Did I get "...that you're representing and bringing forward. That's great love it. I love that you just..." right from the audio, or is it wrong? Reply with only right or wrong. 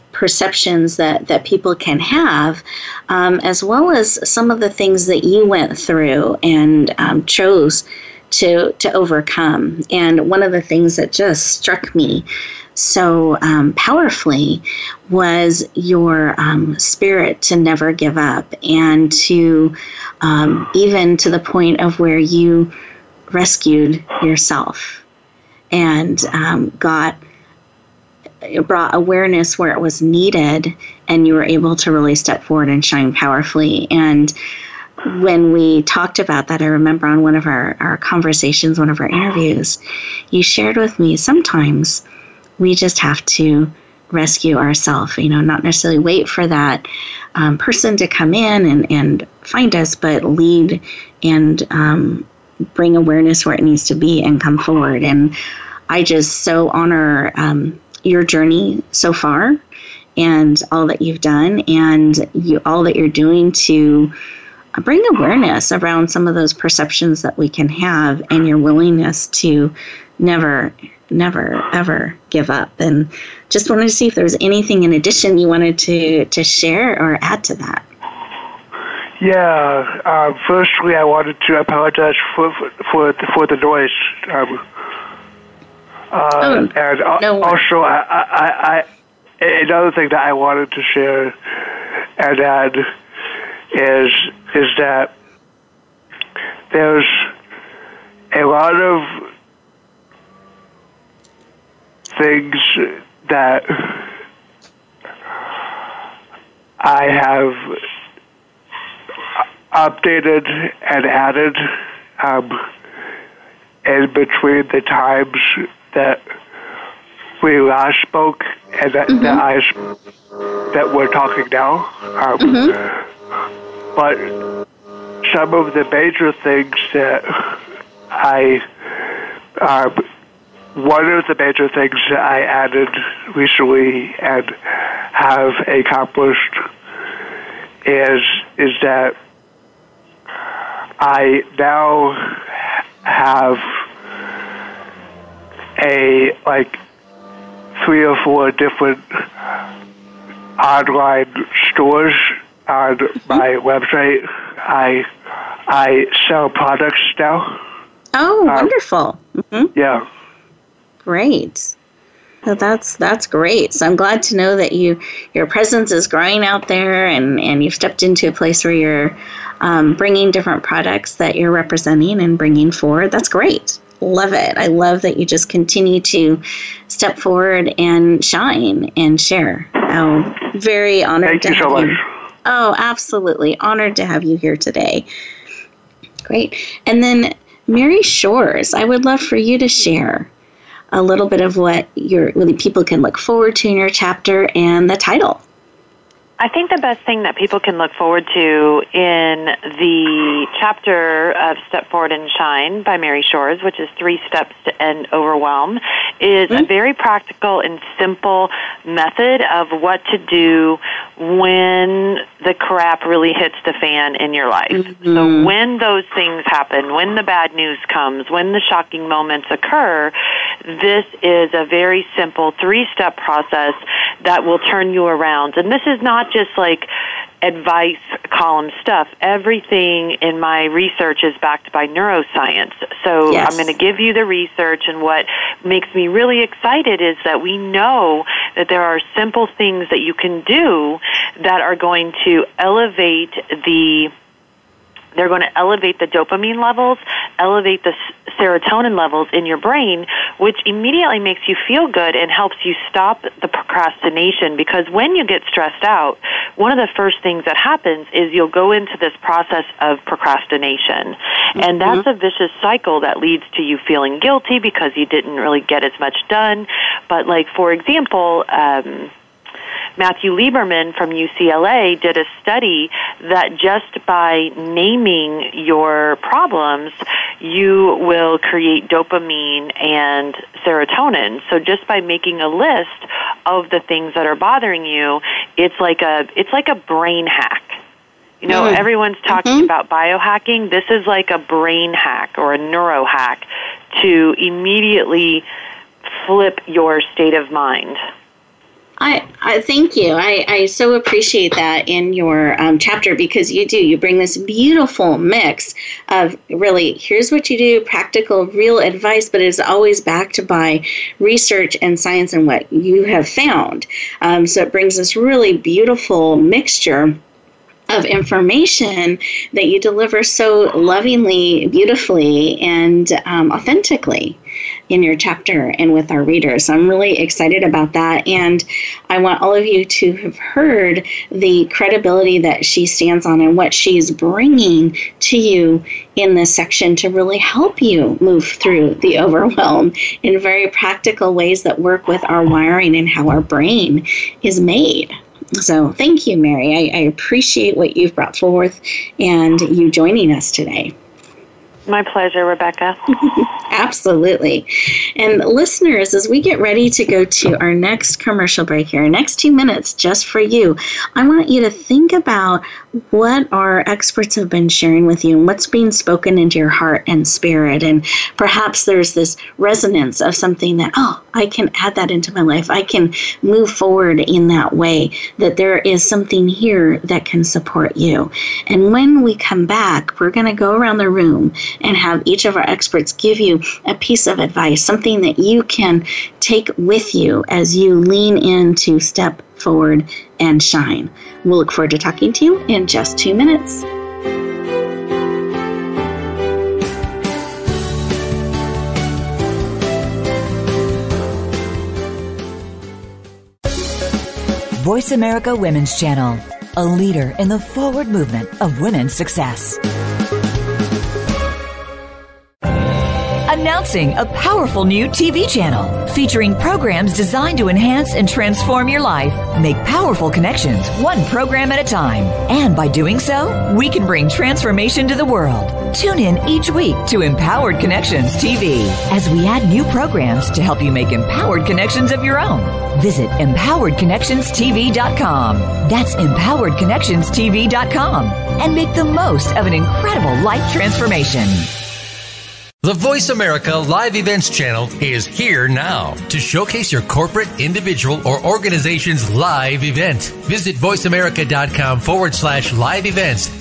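right.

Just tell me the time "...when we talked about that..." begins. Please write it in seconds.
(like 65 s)
35 s.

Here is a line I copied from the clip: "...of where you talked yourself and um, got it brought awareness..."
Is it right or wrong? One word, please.
wrong.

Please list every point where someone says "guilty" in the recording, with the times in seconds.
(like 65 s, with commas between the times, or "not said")
264 s.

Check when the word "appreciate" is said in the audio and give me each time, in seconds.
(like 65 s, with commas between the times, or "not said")
300 s, 347 s.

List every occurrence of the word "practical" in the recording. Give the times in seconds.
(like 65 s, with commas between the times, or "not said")
206 s, 307 s, 340 s.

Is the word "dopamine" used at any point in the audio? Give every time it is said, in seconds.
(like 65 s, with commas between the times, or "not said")
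246 s, 278 s.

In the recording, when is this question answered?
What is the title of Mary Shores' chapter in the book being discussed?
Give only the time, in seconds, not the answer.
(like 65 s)
203 s.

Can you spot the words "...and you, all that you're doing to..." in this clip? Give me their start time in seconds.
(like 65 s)
61 s.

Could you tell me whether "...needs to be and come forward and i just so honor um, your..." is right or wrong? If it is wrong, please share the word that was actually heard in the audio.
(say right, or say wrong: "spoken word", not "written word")
right.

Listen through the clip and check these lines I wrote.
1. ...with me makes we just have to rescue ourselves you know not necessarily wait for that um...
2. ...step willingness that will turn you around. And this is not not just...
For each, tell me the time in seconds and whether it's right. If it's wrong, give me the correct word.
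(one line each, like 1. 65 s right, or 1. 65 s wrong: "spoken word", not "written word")
1. 40 s wrong: "sometimes", not "makes"
2. 222 s wrong: "process", not "willingness".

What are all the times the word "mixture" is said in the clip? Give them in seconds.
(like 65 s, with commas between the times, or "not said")
316 s.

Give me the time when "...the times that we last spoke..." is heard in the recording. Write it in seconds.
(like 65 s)
114 s.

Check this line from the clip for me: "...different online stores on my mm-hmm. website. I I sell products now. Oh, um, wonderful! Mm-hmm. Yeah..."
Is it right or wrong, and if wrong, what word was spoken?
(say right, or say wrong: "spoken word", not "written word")
right.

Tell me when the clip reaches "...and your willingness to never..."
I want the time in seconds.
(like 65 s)
68 s.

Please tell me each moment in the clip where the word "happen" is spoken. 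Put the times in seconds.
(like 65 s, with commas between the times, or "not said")
216 s, 257 s.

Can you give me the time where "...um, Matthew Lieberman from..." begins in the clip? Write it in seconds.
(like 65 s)
268 s.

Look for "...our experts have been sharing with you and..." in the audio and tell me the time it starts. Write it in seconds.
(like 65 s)
363 s.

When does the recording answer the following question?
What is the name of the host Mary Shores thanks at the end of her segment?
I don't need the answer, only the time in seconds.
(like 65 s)
352 s.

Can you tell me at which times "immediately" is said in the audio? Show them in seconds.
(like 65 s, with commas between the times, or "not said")
250 s, 294 s.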